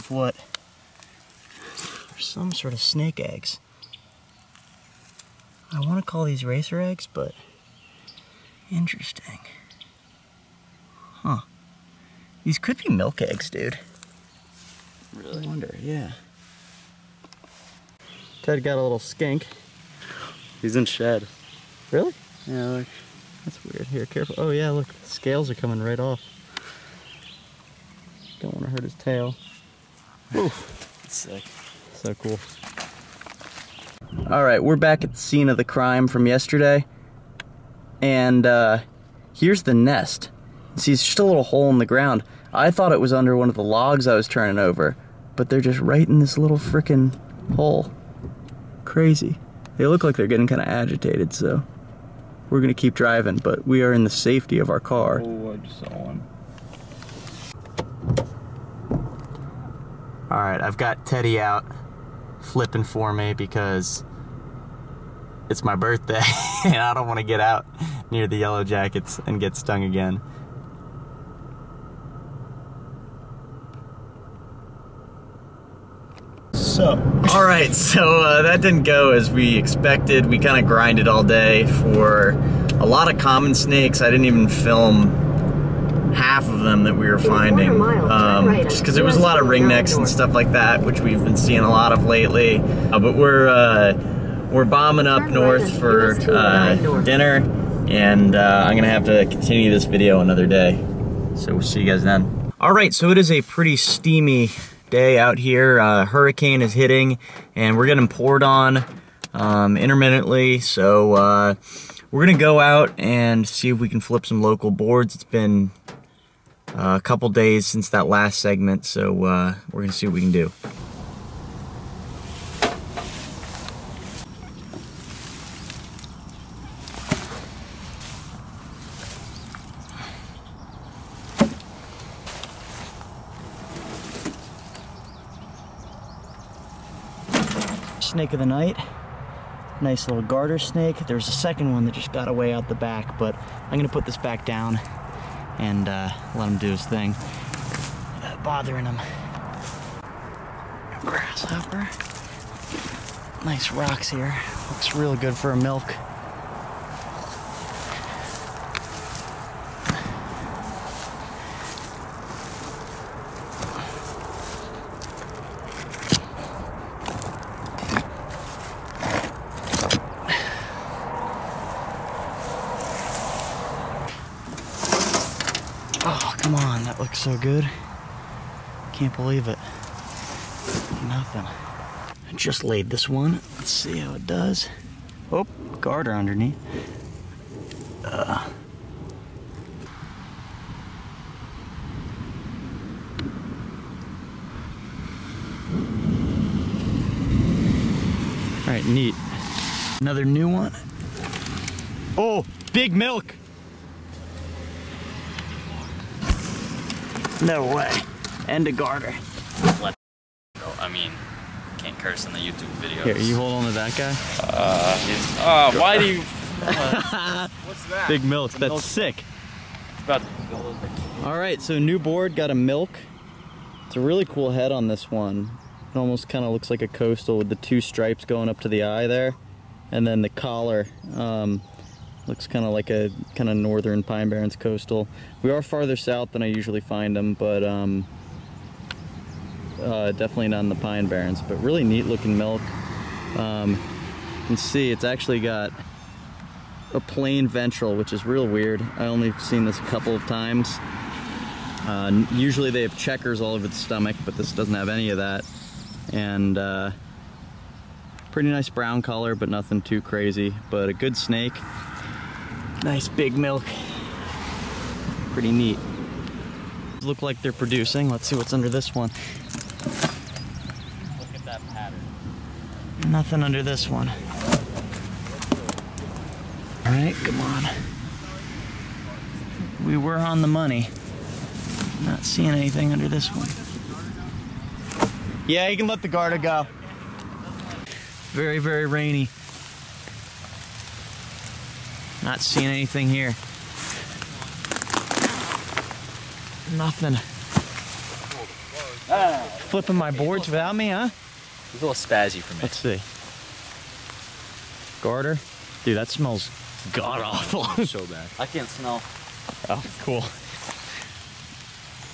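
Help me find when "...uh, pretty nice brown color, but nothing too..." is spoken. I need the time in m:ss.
4:16.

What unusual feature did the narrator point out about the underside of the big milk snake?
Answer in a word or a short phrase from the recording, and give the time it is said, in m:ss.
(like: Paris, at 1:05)
Plain ventral, at 4:07.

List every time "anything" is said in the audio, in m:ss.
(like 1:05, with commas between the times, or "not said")
4:42, 4:52.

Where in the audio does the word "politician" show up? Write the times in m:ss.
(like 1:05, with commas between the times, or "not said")
not said.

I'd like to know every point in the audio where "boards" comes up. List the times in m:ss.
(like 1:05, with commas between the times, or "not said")
1:54, 3:41, 5:00.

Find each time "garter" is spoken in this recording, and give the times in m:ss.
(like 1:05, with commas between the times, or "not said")
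2:20, 3:05, 3:28, 4:46, 5:05.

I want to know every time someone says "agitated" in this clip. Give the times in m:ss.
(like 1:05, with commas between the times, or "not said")
0:50.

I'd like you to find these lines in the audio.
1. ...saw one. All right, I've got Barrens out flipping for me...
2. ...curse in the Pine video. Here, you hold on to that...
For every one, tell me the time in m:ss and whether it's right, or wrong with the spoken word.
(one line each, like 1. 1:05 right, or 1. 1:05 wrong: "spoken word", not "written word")
1. 0:55 wrong: "Teddy", not "Barrens"
2. 3:31 wrong: "YouTube", not "Pine".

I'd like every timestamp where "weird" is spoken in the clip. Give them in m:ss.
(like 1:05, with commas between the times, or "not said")
0:23, 4:08.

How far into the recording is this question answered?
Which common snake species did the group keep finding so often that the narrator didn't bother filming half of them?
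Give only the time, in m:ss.
1:29.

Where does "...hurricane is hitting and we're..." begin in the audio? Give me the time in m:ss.
1:46.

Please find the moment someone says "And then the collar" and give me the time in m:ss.
3:49.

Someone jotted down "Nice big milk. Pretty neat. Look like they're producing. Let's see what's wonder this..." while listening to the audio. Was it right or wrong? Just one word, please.
wrong.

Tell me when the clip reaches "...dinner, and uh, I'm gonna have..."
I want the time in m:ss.
1:37.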